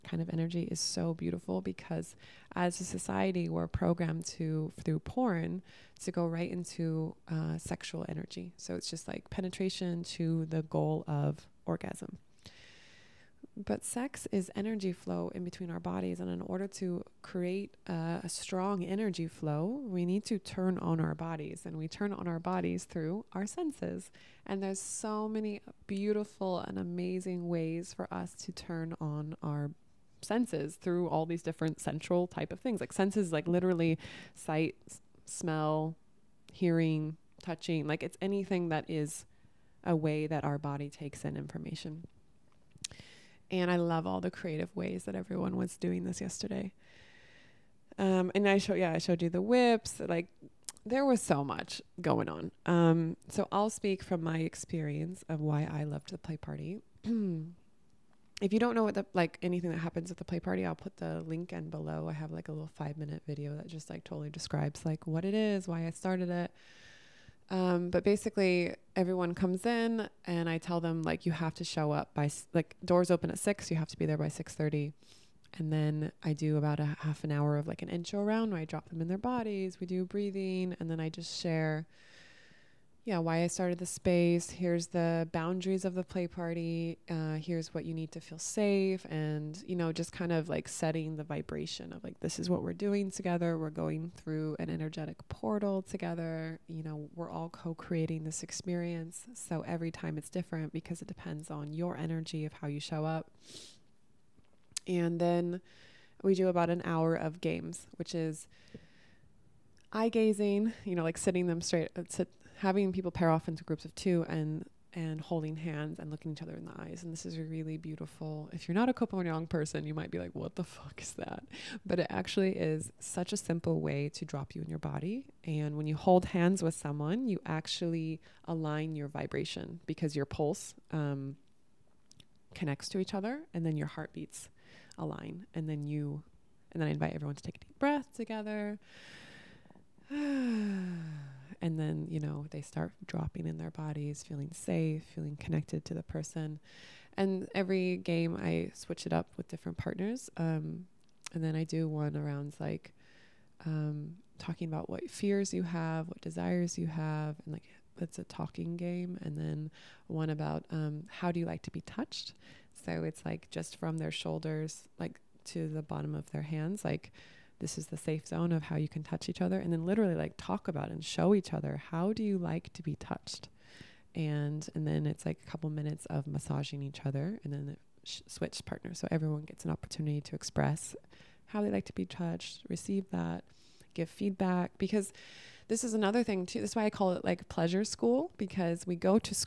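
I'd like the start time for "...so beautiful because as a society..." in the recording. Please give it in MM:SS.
00:00.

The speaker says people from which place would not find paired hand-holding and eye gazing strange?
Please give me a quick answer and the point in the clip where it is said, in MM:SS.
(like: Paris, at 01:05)
Koh Phangan, at 01:58.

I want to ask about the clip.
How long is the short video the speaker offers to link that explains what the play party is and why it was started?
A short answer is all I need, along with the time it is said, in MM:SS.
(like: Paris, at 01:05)
5 minutes, at 01:02.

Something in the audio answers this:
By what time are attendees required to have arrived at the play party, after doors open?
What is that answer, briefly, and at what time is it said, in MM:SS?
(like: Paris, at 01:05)
6:30, at 01:14.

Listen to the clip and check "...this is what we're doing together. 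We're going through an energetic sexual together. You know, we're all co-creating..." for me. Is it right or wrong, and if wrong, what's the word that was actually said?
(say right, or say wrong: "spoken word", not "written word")
wrong: "portal", not "sexual".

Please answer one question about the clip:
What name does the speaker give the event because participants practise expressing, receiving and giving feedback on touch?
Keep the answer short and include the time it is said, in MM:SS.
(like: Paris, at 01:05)
Pleasure school, at 03:07.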